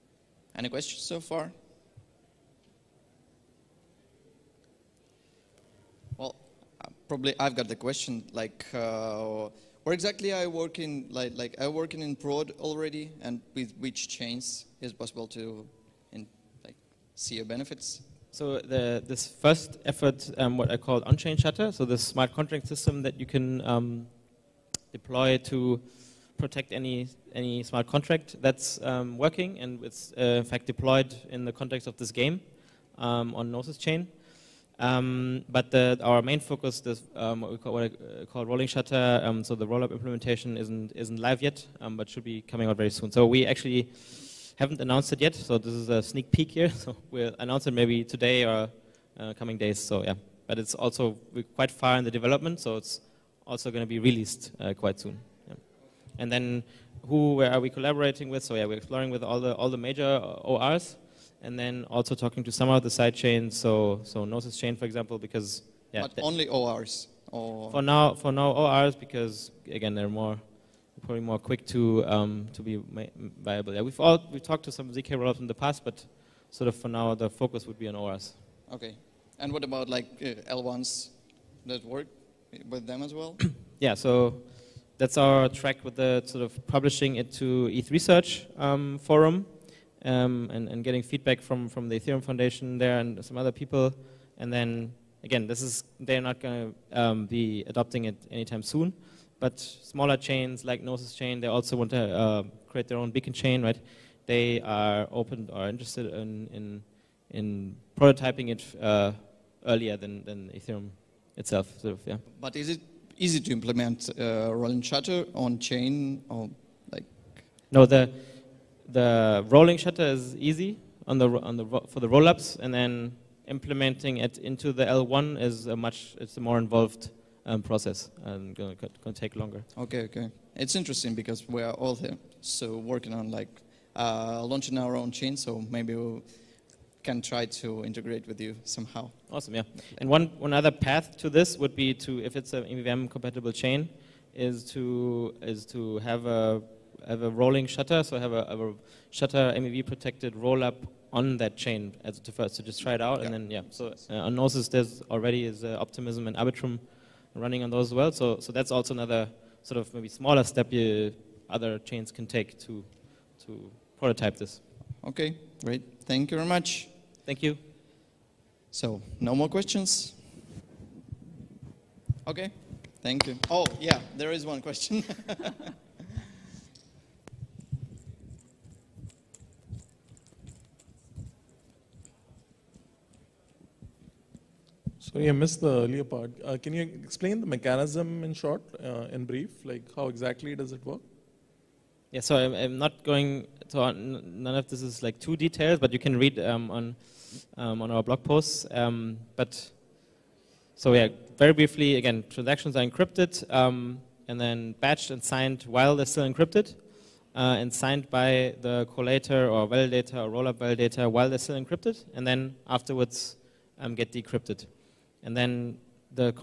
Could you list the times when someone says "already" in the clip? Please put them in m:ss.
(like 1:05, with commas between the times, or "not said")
0:12, 2:35.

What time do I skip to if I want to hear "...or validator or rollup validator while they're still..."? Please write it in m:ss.
3:29.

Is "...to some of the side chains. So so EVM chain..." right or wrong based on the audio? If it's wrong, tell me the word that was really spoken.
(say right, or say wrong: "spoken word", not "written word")
wrong: "Gnosis", not "EVM".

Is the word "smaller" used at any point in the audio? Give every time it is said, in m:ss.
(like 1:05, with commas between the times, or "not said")
1:39, 2:40.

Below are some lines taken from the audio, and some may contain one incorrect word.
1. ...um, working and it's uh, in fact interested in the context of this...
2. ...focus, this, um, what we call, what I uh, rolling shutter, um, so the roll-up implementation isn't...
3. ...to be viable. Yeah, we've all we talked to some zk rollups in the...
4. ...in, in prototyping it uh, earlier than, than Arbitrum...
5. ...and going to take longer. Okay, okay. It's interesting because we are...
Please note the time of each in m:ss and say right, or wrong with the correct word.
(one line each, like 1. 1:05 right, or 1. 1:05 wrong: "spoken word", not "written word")
1. 0:28 wrong: "deployed", not "interested"
2. 0:36 right
3. 1:12 right
4. 1:46 wrong: "Ethereum", not "Arbitrum"
5. 2:08 right.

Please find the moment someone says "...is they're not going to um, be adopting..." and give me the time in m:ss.
1:35.